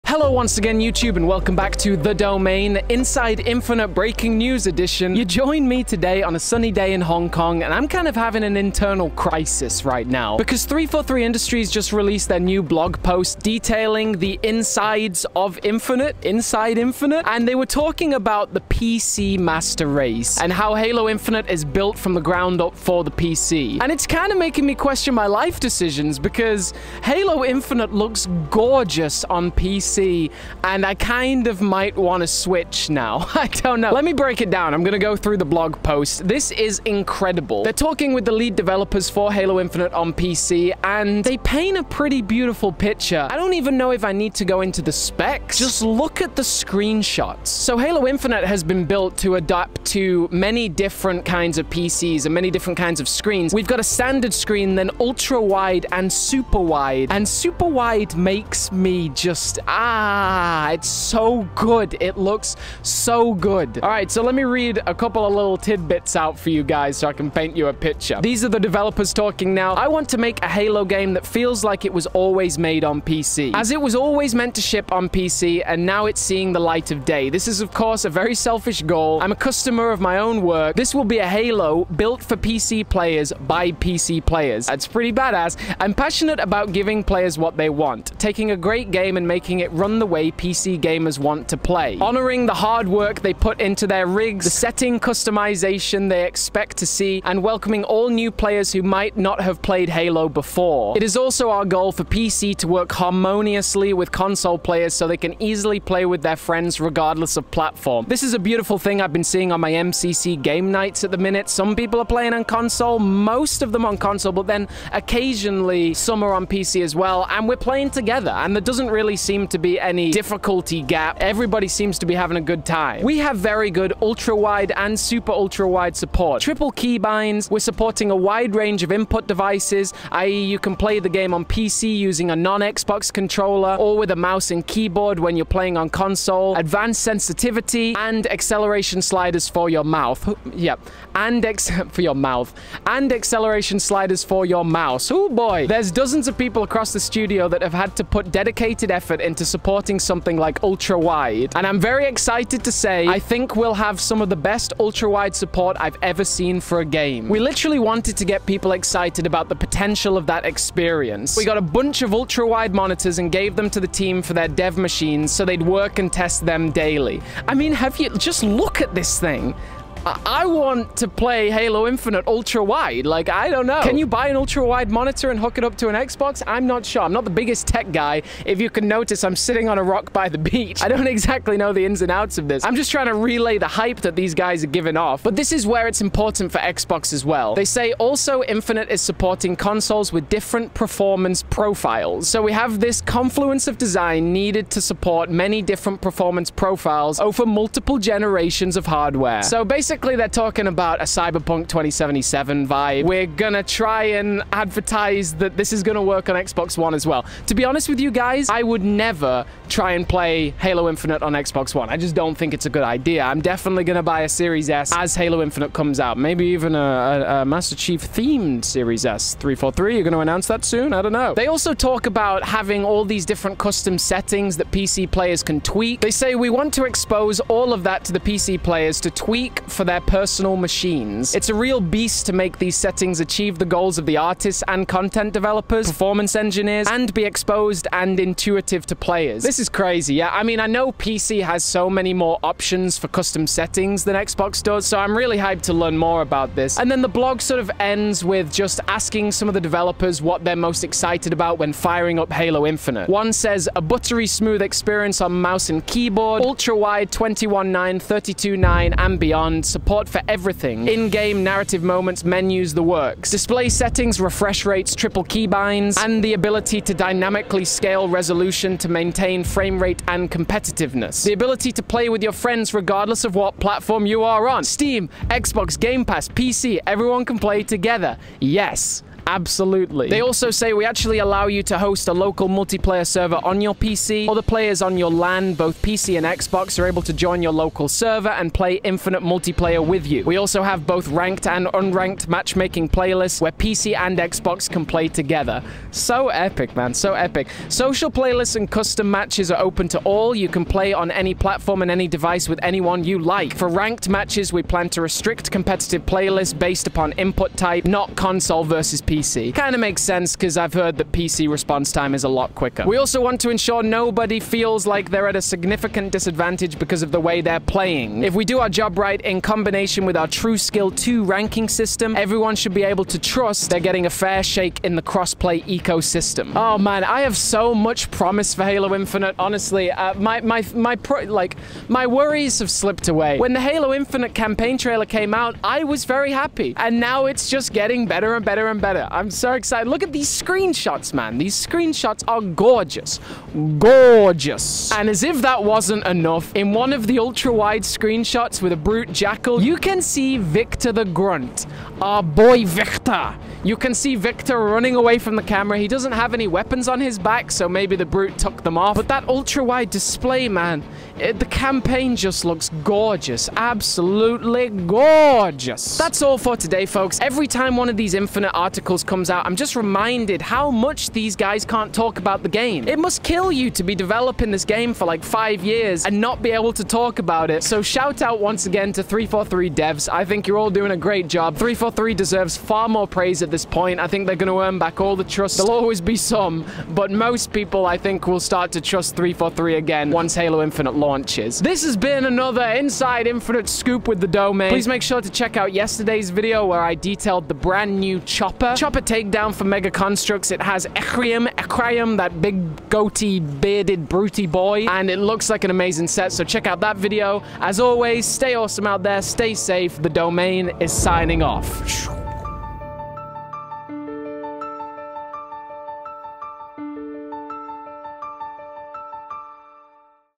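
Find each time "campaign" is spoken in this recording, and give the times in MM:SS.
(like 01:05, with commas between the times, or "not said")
05:34, 06:01.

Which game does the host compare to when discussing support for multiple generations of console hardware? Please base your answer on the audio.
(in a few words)
Cyberpunk 2077.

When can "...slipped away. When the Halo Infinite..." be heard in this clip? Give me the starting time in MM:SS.
05:32.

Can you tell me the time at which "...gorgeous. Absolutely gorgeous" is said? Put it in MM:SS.
06:02.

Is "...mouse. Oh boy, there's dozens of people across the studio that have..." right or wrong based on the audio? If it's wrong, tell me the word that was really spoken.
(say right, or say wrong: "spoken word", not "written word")
right.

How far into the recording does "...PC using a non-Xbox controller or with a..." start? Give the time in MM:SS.
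02:11.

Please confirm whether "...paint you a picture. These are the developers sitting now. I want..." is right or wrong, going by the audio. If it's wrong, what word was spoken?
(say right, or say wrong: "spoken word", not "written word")
wrong: "talking", not "sitting".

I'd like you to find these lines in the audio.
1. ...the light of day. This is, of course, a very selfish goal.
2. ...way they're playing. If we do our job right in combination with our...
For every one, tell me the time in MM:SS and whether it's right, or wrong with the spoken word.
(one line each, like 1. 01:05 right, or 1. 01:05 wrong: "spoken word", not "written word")
1. 01:16 right
2. 05:17 right.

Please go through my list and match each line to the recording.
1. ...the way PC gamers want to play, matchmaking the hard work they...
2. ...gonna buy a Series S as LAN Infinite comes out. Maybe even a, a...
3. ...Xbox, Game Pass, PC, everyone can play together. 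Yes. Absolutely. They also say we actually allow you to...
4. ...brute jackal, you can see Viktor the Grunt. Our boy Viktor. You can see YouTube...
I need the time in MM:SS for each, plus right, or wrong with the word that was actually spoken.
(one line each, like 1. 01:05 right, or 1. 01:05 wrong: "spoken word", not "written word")
1. 01:29 wrong: "honoring", not "matchmaking"
2. 03:33 wrong: "Halo", not "LAN"
3. 04:35 right
4. 05:48 wrong: "Viktor", not "YouTube".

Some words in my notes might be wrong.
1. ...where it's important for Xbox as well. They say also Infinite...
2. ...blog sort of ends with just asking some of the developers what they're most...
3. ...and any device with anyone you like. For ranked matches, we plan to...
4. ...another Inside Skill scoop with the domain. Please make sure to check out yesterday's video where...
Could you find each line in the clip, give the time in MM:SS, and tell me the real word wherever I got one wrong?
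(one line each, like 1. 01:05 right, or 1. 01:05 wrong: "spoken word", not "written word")
1. 03:05 right
2. 04:07 right
3. 05:01 right
4. 06:32 wrong: "Infinite", not "Skill".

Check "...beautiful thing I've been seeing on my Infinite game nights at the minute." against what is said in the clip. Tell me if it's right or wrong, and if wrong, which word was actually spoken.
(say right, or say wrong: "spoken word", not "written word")
wrong: "MCC", not "Infinite".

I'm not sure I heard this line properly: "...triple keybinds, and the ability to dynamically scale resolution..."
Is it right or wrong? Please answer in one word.
right.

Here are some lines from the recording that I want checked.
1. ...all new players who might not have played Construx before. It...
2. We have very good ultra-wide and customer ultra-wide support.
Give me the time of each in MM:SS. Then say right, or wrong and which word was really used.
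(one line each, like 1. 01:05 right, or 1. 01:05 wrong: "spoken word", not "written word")
1. 01:37 wrong: "Halo", not "Construx"
2. 02:03 wrong: "super", not "customer".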